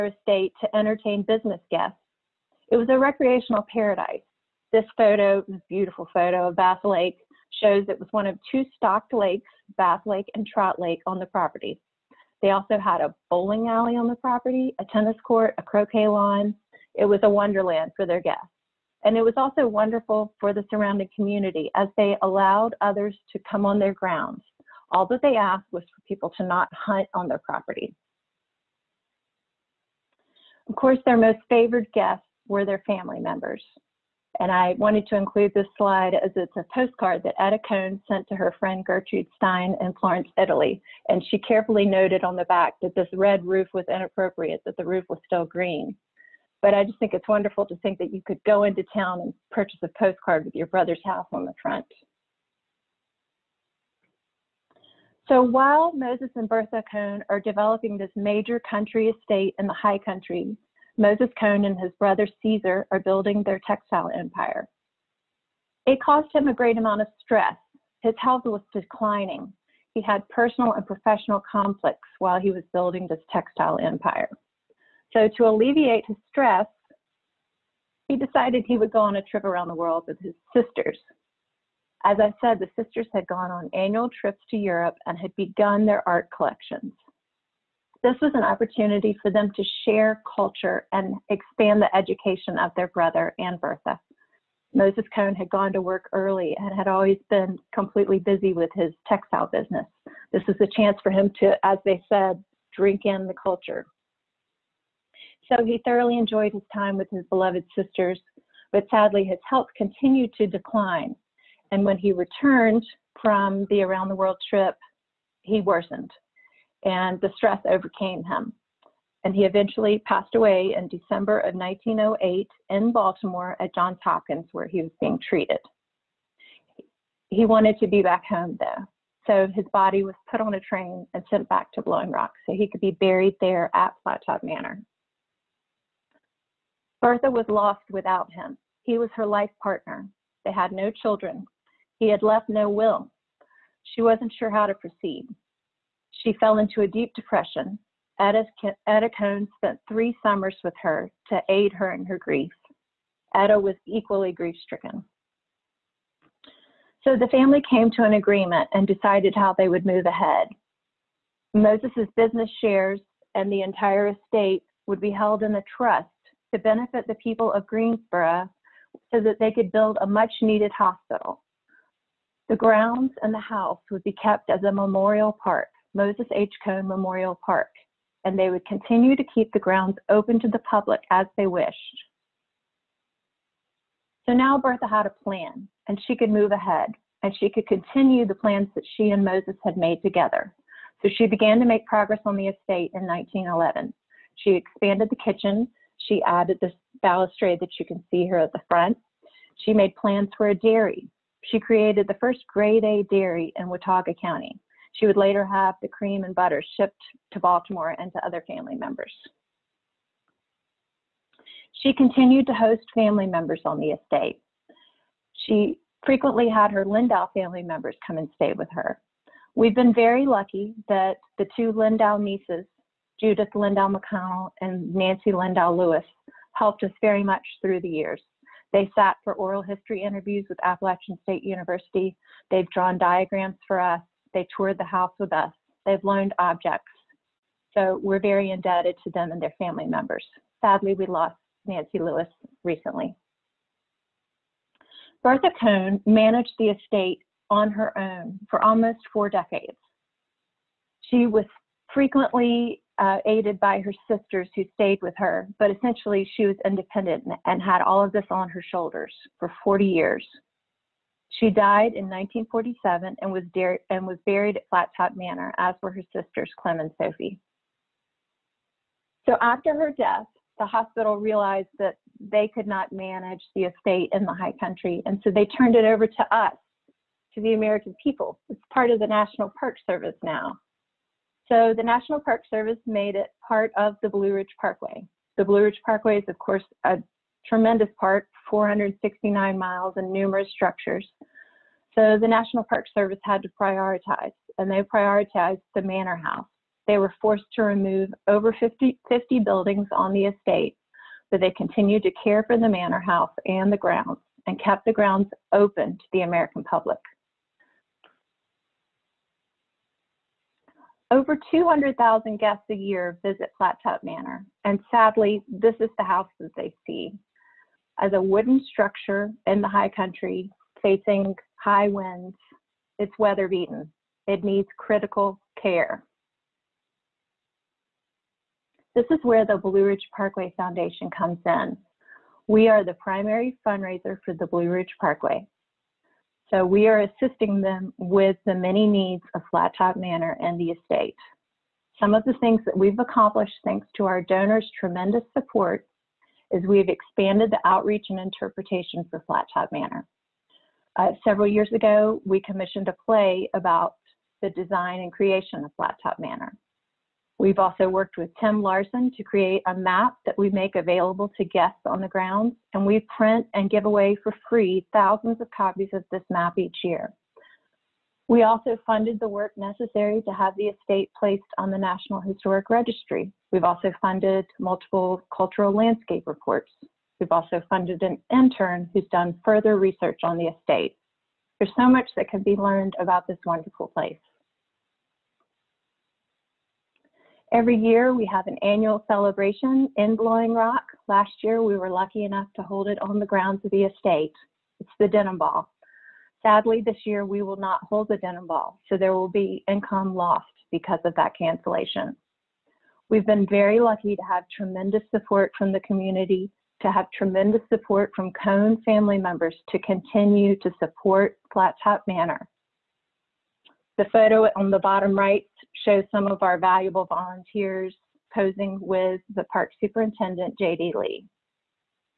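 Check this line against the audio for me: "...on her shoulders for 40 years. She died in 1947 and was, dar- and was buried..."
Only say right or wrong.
right.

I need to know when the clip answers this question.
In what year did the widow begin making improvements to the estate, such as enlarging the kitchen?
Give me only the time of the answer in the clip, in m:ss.
3:13.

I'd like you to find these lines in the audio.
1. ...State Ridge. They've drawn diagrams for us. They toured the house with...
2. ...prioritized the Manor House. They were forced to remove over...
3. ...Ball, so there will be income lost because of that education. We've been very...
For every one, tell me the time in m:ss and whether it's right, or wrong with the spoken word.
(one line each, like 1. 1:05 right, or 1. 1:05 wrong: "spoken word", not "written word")
1. 3:51 wrong: "University", not "Ridge"
2. 4:54 right
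3. 6:38 wrong: "cancellation", not "education".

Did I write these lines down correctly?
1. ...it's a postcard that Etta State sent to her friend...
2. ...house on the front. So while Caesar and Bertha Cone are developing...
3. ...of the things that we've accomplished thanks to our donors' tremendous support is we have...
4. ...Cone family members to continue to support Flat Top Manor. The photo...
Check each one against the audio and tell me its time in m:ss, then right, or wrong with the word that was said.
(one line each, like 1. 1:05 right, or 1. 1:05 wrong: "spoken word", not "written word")
1. 0:36 wrong: "Cone", not "State"
2. 0:51 wrong: "Moses", not "Caesar"
3. 5:42 right
4. 6:48 right.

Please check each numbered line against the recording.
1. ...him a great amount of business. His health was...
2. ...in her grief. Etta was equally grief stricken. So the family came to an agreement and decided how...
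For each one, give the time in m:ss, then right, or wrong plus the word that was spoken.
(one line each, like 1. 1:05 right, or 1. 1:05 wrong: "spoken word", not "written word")
1. 1:06 wrong: "stress", not "business"
2. 2:31 right.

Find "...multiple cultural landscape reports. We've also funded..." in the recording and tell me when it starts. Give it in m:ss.
6:14.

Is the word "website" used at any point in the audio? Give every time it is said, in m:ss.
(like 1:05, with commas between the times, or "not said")
not said.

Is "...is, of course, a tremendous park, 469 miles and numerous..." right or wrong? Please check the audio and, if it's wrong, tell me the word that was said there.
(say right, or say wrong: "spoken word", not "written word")
right.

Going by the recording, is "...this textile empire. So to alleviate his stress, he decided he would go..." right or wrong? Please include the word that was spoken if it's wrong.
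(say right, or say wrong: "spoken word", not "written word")
right.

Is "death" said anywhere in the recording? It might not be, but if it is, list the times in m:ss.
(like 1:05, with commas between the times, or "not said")
4:29.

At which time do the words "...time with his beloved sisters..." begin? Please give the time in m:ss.
1:46.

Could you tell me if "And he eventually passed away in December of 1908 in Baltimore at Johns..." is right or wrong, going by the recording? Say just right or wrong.
right.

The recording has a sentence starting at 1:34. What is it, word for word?
Moses Cone had gone to work early and had always been completely busy with his textile business.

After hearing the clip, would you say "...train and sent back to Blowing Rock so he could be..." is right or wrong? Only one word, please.
right.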